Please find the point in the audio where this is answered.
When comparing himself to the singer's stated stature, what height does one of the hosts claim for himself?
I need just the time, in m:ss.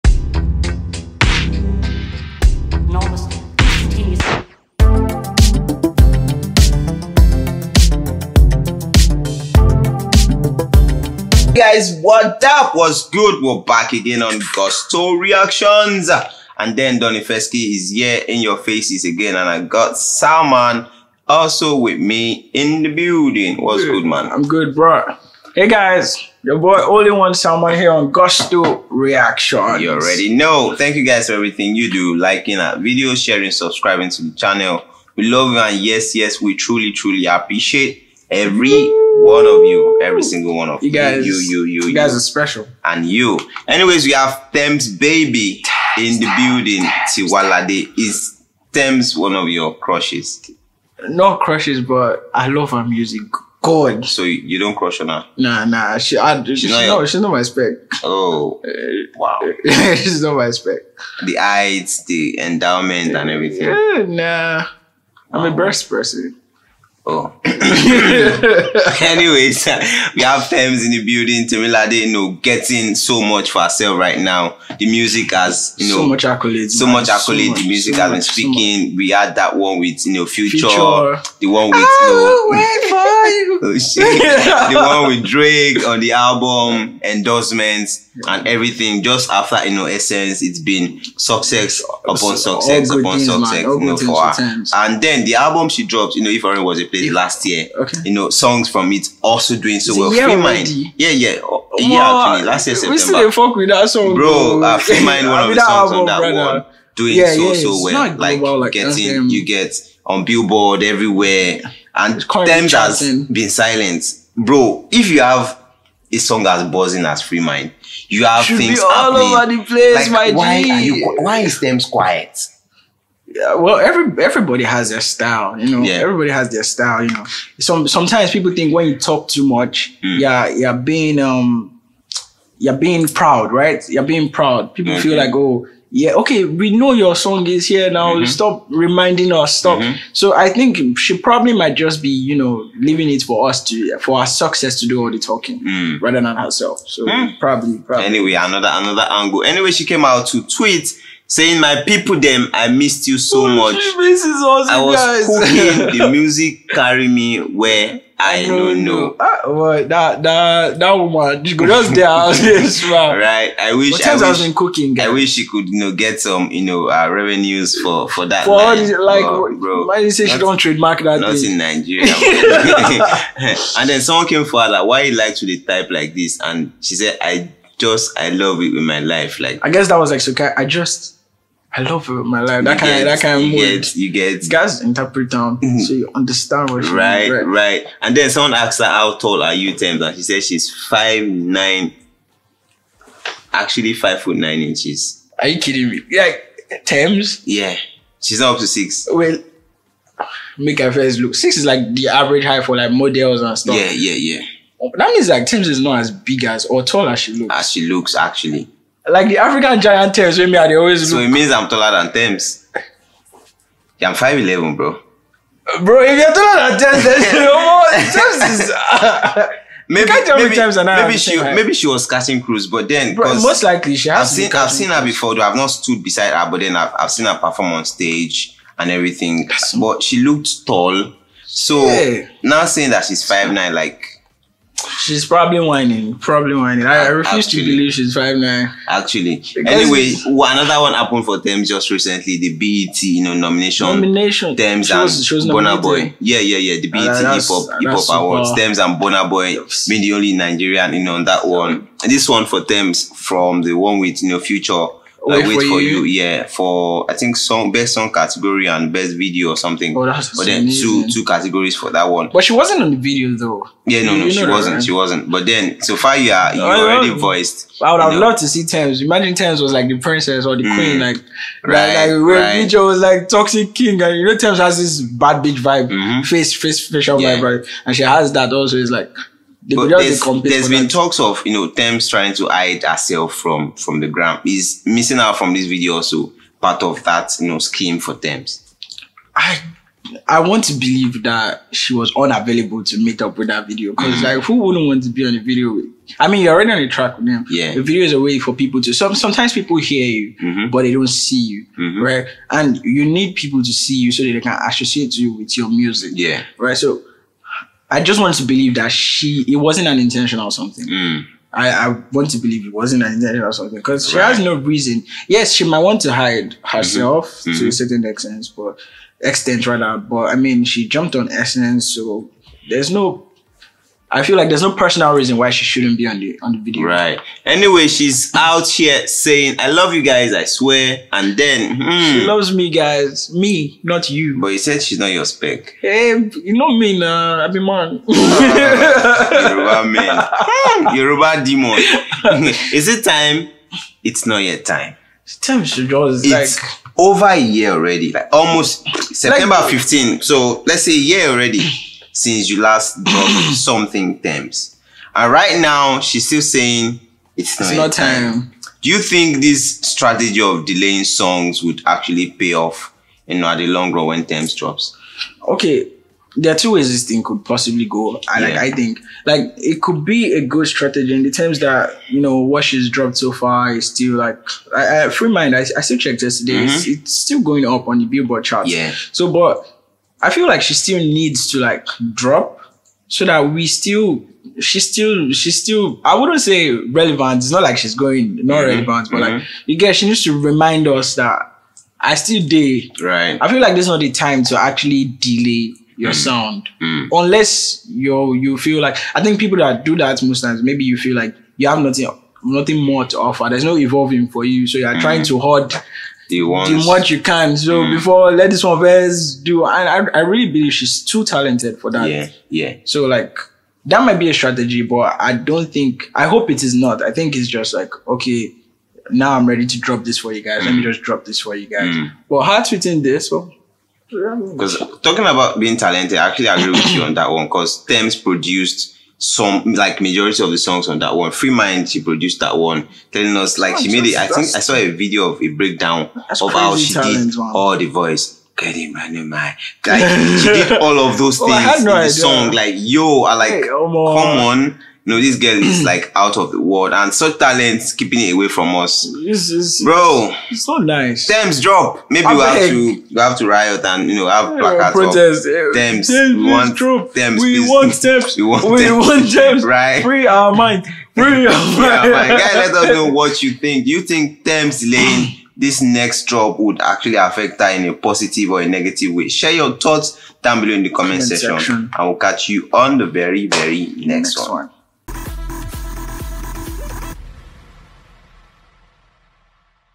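3:34.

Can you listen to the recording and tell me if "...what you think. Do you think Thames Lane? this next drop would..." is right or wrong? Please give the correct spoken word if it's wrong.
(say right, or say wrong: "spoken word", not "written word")
right.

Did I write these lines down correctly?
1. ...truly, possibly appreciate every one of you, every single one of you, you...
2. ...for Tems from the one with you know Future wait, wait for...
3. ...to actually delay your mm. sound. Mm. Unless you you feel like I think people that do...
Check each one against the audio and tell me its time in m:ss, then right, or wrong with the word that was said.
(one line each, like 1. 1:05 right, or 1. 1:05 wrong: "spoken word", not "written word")
1. 0:36 wrong: "truly", not "possibly"
2. 4:12 right
3. 6:34 right.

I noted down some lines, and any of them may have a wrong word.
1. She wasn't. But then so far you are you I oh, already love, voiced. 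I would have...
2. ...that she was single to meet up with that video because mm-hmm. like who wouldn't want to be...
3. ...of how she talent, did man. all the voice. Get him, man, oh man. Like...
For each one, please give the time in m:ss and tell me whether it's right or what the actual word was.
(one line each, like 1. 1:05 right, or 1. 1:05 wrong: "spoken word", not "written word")
1. 4:24 right
2. 4:51 wrong: "unavailable", not "single"
3. 7:16 right.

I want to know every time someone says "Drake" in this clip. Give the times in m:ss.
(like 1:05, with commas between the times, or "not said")
1:25.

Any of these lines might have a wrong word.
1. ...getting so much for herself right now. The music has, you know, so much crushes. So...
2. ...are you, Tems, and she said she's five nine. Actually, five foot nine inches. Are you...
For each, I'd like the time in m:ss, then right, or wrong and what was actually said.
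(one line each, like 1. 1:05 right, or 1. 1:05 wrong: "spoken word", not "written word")
1. 1:12 wrong: "accolades", not "crushes"
2. 3:09 right.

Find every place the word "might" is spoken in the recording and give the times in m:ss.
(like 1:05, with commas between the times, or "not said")
2:21, 5:15, 6:54.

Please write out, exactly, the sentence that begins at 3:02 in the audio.
That kind, that kind you mood.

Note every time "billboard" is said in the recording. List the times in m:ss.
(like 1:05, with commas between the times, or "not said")
1:50, 6:18.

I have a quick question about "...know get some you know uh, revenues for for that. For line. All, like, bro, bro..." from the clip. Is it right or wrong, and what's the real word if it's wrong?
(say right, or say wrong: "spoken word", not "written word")
right.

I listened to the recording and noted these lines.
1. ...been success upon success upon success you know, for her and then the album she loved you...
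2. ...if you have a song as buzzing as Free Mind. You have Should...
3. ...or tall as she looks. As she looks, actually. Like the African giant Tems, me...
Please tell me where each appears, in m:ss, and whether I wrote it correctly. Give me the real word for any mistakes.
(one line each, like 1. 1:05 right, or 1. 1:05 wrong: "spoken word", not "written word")
1. 1:30 wrong: "dropped", not "loved"
2. 1:54 right
3. 3:26 right.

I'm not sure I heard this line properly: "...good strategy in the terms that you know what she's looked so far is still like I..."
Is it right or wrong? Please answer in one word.
wrong.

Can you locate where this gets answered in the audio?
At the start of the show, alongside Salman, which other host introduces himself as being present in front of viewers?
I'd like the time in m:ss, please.
0:16.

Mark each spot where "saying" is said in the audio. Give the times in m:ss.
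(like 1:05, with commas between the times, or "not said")
2:31, 3:52, 5:29, 5:56.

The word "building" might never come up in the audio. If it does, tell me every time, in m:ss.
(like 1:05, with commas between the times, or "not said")
0:22, 0:46, 1:11.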